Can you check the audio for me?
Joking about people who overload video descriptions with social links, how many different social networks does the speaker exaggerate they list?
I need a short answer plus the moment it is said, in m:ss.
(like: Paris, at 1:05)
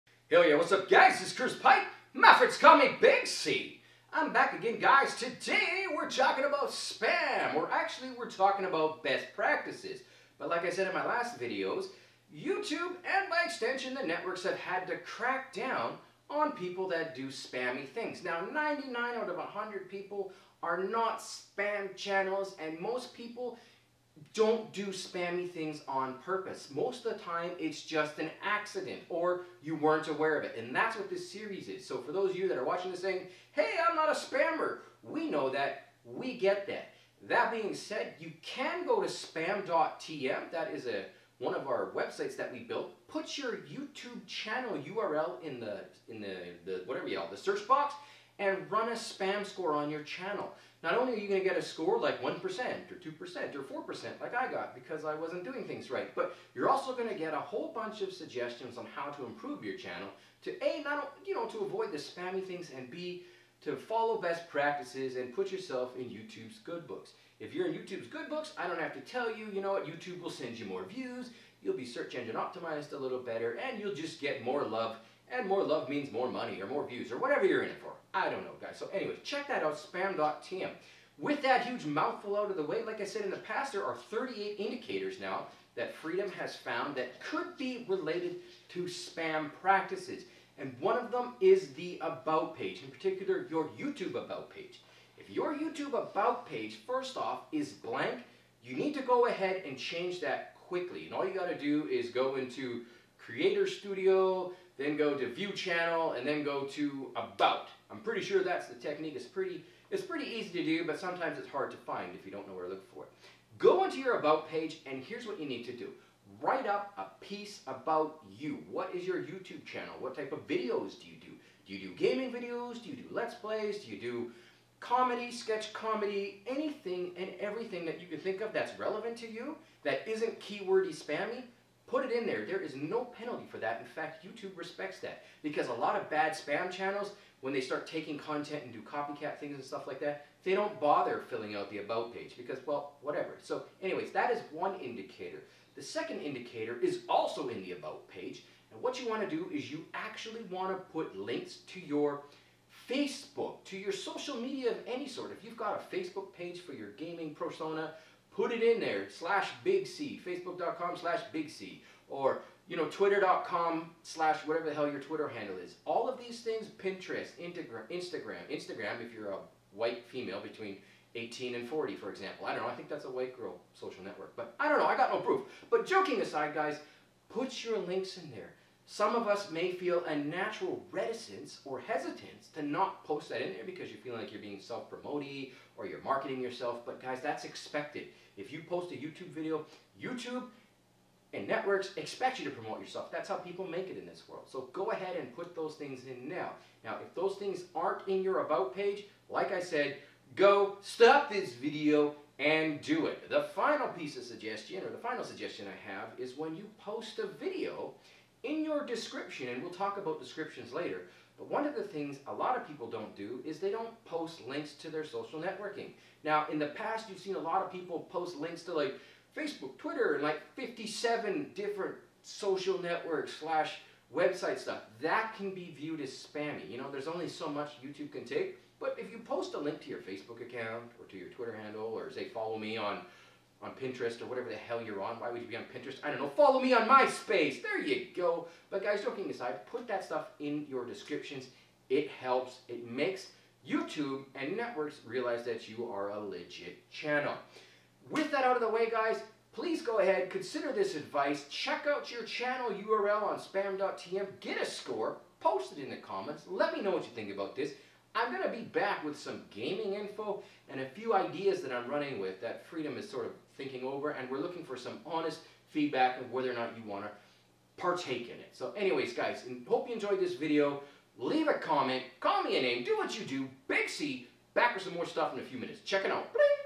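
57, at 3:40.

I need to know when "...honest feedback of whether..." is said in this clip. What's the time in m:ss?
4:25.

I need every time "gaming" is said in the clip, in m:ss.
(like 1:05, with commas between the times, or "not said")
2:01, 2:36, 4:19.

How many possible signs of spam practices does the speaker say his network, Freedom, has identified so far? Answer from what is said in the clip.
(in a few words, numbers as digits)
38.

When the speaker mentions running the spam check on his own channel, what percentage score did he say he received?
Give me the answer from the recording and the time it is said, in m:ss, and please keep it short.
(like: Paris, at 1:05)
4%, at 0:53.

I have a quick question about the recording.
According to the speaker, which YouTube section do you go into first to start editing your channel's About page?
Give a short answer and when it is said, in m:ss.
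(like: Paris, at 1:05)
Creator Studio, at 1:43.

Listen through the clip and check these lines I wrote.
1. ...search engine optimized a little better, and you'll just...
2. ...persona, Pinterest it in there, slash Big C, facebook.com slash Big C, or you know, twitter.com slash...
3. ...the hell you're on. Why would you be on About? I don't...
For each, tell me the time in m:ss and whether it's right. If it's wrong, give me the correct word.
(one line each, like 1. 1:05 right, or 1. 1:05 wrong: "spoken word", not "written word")
1. 1:11 right
2. 2:37 wrong: "Put", not "Pinterest"
3. 3:54 wrong: "Pinterest", not "About".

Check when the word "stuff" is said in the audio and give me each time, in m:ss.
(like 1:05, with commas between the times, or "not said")
2:19, 3:44, 4:00, 4:35.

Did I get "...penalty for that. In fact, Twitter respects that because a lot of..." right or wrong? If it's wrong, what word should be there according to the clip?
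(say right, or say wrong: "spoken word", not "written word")
wrong: "YouTube", not "Twitter".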